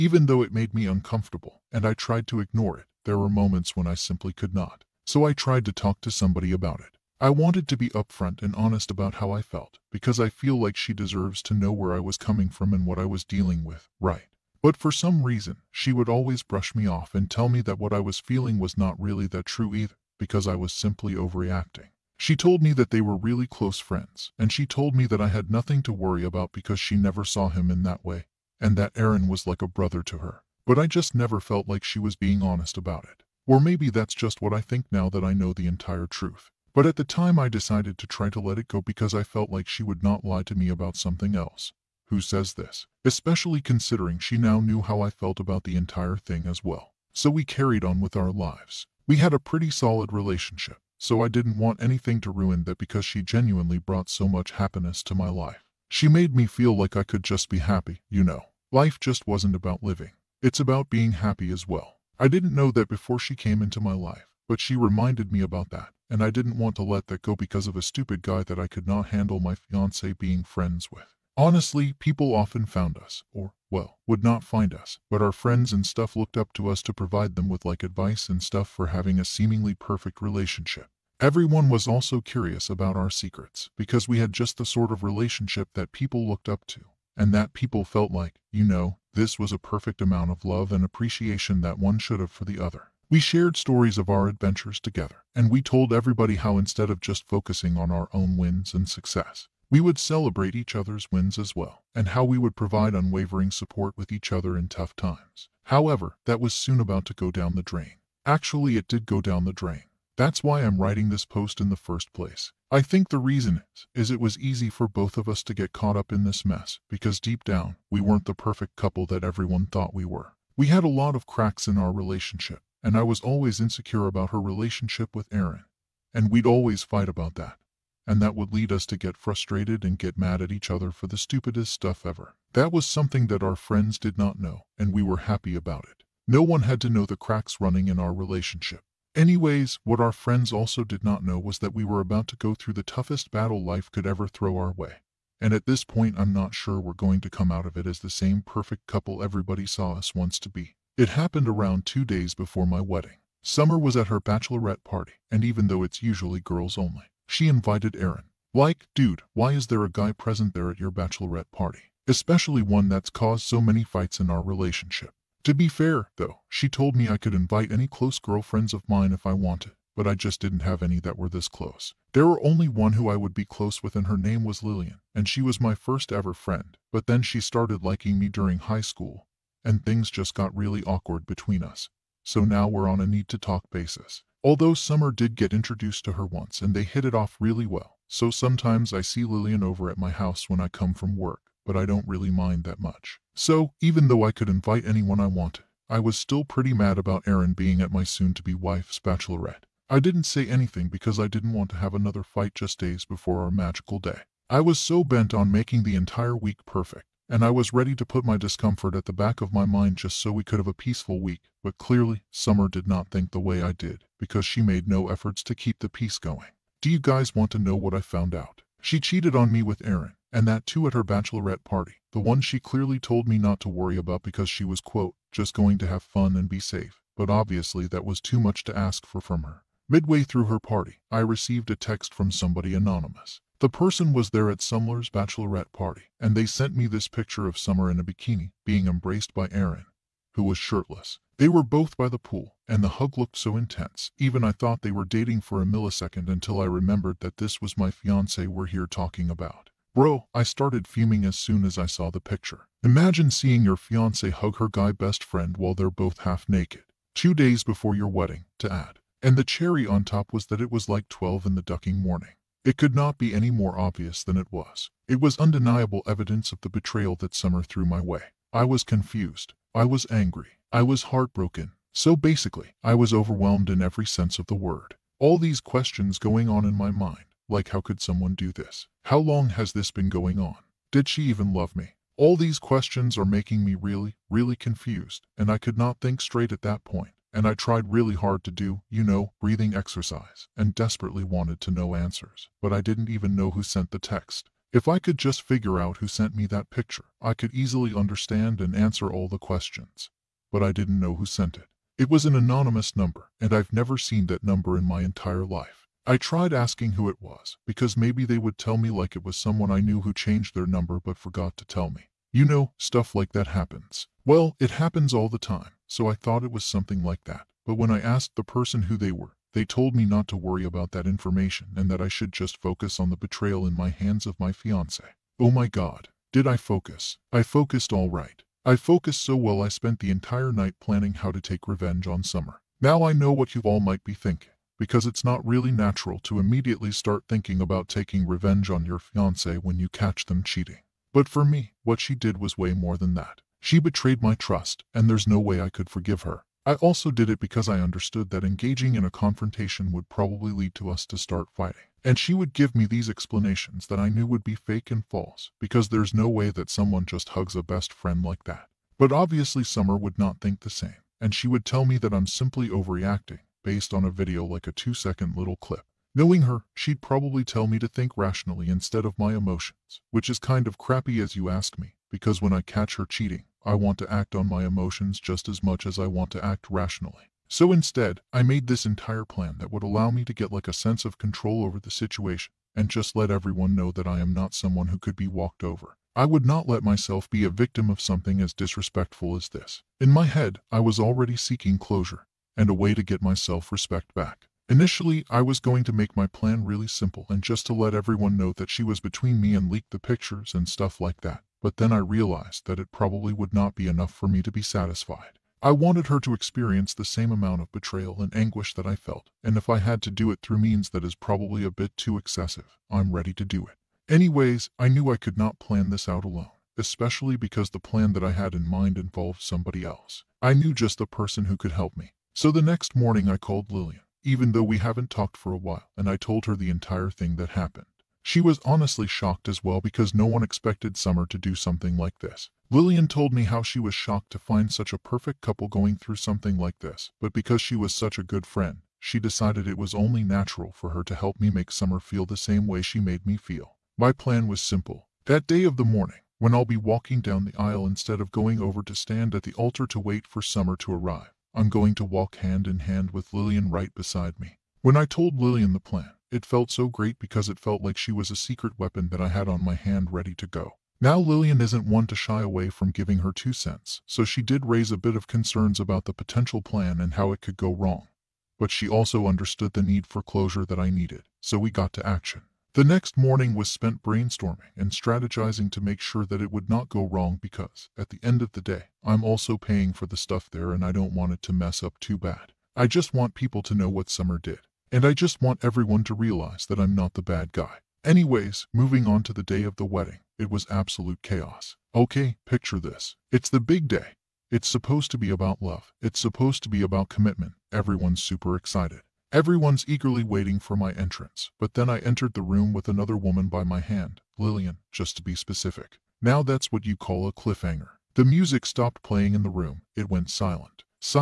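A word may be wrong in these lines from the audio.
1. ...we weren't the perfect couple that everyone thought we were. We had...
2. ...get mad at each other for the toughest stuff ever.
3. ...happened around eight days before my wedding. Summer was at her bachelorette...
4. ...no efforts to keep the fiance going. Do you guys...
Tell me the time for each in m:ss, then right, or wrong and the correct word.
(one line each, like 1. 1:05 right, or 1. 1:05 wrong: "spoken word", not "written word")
1. 1:57 right
2. 2:09 wrong: "stupidest", not "toughest"
3. 2:31 wrong: "two", not "eight"
4. 3:34 wrong: "peace", not "fiance".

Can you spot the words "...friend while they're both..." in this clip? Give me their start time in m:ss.
4:15.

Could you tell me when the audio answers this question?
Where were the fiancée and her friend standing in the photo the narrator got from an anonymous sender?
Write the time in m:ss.
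4:01.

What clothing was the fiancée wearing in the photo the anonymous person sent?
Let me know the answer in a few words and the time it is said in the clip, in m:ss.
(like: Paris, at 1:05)
Bikini, at 3:58.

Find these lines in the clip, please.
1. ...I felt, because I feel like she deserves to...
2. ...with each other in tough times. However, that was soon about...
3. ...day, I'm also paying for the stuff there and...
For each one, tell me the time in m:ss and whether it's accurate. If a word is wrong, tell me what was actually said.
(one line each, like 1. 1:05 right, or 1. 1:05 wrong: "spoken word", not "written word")
1. 0:09 right
2. 1:43 right
3. 7:58 right.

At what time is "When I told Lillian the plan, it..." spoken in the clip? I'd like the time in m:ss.
7:34.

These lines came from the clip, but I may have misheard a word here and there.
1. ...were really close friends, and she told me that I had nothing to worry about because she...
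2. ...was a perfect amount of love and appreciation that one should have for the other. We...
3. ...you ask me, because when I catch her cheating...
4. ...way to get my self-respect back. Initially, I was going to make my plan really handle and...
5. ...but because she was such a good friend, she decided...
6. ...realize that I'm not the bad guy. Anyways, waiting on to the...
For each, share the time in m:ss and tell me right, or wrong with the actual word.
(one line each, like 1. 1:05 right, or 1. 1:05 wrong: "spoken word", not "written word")
1. 0:22 right
2. 1:29 right
3. 6:11 right
4. 6:32 wrong: "simple", not "handle"
5. 7:17 right
6. 8:06 wrong: "moving", not "waiting".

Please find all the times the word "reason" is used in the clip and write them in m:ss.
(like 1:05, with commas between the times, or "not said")
0:15, 1:53.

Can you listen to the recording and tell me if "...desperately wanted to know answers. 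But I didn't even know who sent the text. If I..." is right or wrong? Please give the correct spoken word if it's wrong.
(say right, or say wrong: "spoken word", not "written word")
right.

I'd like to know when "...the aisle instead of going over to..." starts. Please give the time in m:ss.
7:27.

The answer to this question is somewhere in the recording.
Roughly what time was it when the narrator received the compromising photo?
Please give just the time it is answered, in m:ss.
4:21.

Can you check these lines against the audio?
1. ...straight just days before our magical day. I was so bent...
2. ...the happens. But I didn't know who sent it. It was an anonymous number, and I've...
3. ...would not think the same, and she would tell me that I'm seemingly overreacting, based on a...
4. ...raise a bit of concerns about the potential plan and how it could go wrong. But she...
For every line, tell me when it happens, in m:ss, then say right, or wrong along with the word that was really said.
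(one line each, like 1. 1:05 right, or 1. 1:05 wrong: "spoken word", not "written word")
1. 3:22 wrong: "fight", not "straight"
2. 4:59 wrong: "questions", not "happens"
3. 5:59 wrong: "simply", not "seemingly"
4. 7:44 right.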